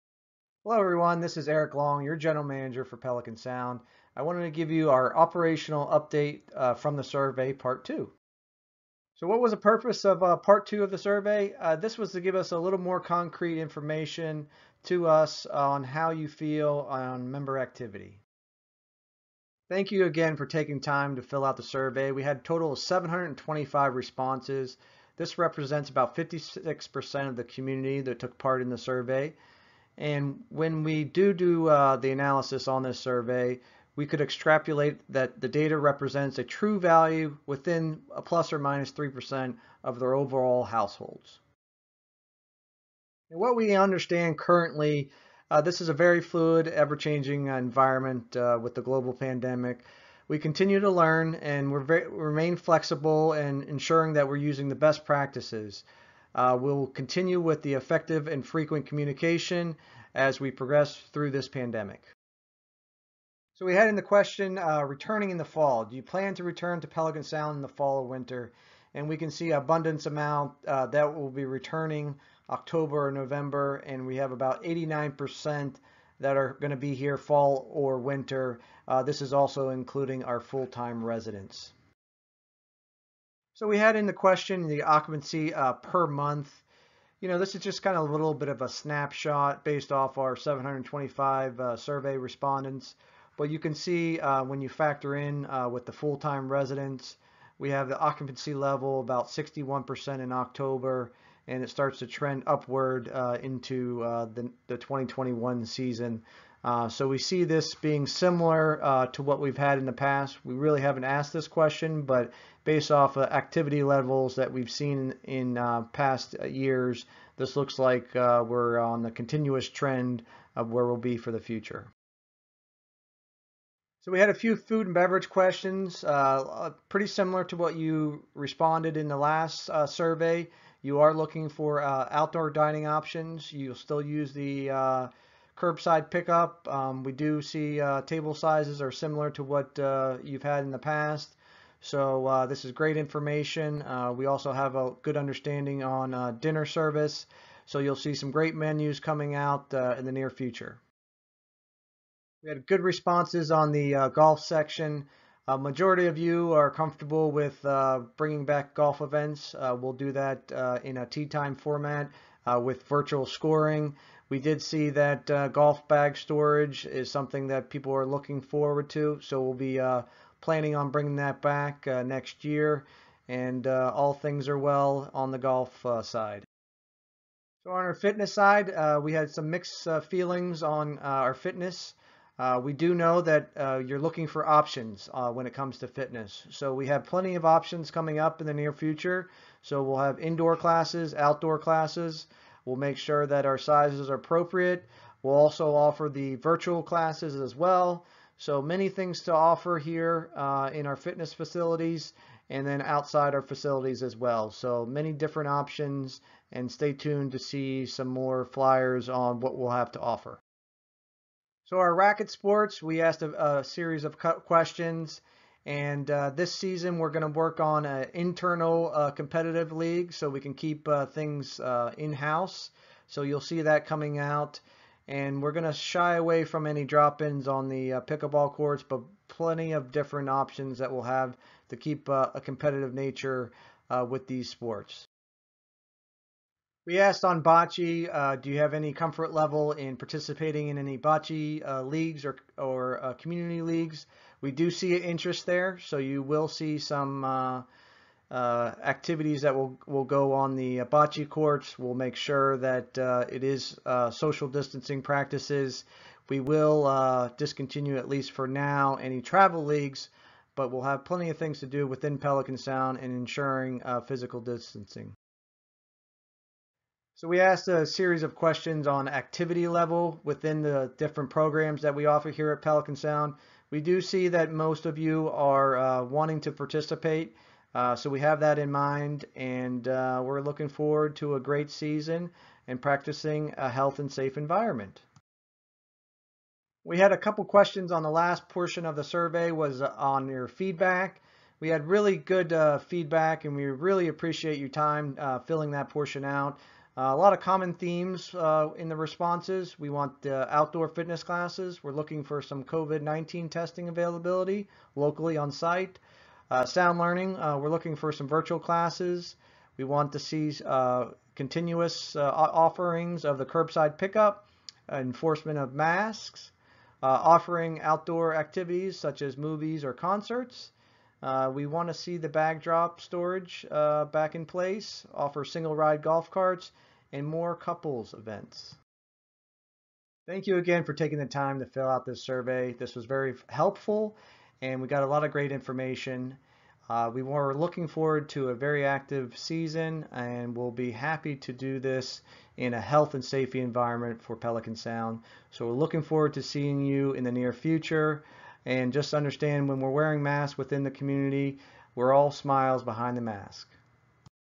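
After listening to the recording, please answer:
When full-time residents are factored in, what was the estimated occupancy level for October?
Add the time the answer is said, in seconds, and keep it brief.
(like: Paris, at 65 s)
61%, at 99 s.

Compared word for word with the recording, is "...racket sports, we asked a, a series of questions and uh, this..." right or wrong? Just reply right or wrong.
right.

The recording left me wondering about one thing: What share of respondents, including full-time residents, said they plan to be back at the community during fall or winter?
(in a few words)
89%.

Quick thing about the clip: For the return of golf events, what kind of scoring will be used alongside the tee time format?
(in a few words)
virtual scoring.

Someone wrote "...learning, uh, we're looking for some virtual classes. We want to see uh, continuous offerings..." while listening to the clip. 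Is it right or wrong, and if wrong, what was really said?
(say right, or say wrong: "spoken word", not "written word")
right.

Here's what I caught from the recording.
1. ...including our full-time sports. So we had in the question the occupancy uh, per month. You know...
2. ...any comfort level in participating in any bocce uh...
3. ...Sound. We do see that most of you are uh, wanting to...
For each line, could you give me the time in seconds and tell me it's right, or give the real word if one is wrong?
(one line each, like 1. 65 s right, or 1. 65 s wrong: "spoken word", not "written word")
1. 79 s wrong: "residents", not "sports"
2. 238 s right
3. 272 s right.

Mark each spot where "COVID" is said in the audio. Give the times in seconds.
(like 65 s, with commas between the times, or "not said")
302 s.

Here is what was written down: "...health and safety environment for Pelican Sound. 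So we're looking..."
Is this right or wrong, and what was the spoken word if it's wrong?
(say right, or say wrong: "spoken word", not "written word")
right.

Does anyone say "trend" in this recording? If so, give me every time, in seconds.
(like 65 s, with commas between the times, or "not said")
102 s, 119 s.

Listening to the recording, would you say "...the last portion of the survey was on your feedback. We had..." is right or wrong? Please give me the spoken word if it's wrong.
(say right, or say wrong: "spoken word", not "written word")
right.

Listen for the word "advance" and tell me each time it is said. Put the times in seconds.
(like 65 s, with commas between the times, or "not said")
not said.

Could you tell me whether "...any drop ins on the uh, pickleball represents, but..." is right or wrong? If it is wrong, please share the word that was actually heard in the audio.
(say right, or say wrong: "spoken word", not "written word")
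wrong: "courts", not "represents".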